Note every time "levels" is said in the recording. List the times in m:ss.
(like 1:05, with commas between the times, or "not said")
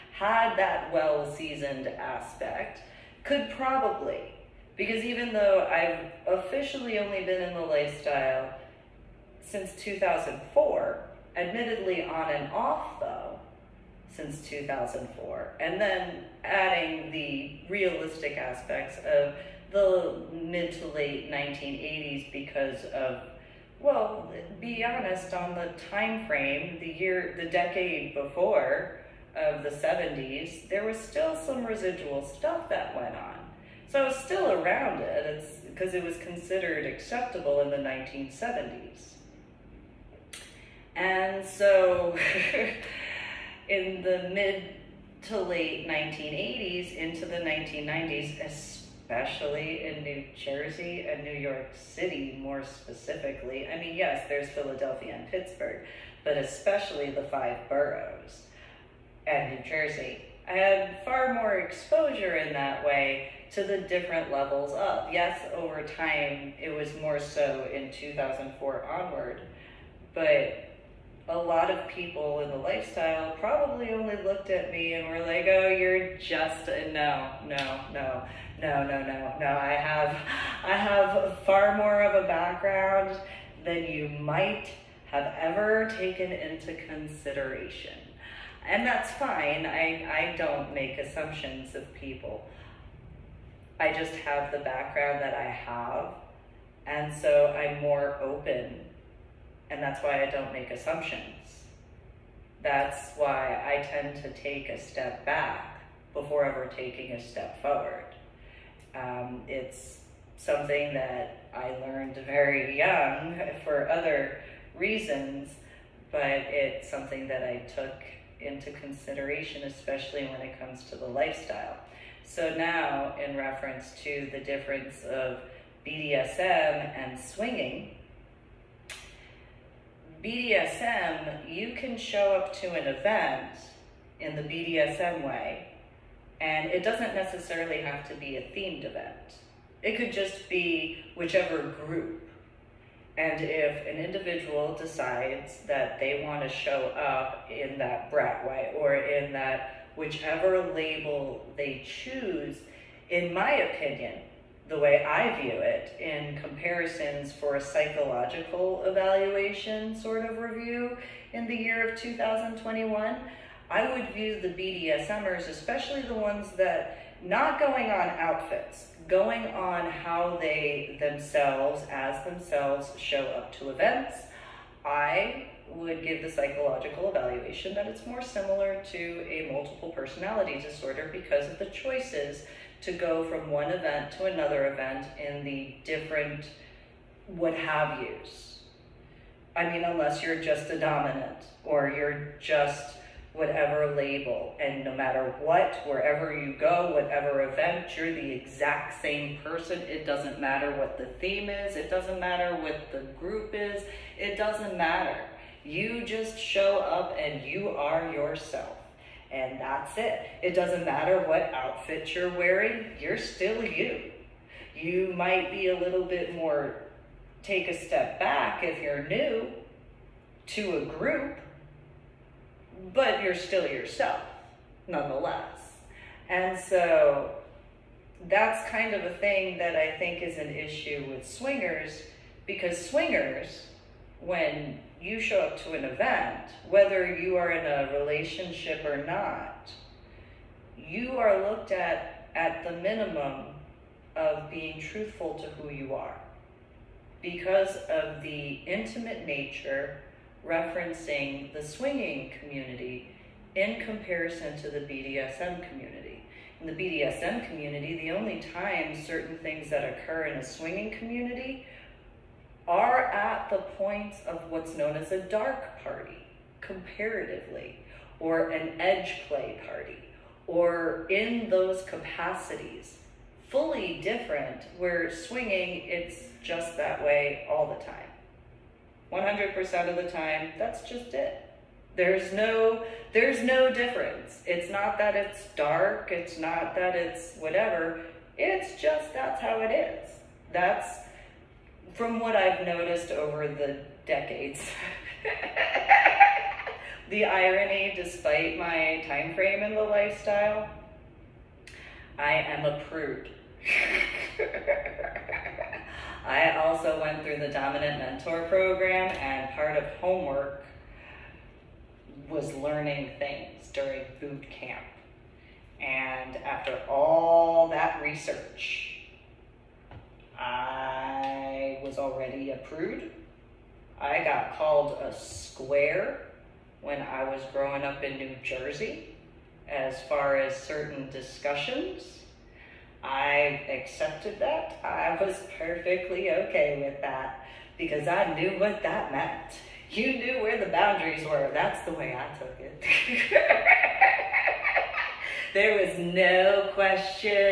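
1:04.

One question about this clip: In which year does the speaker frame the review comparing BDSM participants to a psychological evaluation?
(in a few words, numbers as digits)
2021.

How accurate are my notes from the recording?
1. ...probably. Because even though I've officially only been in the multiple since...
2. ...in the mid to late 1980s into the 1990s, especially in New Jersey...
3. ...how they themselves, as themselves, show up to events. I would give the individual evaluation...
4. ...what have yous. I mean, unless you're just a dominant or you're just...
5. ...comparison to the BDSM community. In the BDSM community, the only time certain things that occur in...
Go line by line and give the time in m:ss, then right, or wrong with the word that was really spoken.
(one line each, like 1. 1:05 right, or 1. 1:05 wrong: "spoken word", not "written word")
1. 0:03 wrong: "lifestyle", not "multiple"
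2. 0:43 right
3. 2:49 wrong: "psychological", not "individual"
4. 3:07 right
5. 4:13 right.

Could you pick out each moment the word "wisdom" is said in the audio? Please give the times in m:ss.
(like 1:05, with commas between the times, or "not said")
not said.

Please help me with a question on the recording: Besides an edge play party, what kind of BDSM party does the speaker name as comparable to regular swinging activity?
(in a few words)
dark party.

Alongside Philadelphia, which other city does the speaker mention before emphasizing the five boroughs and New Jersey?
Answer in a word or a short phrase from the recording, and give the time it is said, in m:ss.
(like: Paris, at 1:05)
Pittsburgh, at 0:55.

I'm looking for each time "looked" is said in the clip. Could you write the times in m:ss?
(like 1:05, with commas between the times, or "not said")
1:14, 4:01.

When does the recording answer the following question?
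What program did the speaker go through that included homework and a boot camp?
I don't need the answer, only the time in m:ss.
5:07.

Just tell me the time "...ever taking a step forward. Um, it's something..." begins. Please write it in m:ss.
1:46.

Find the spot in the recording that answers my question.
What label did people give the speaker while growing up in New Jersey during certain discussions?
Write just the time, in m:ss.
5:25.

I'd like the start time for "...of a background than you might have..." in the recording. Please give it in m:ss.
1:22.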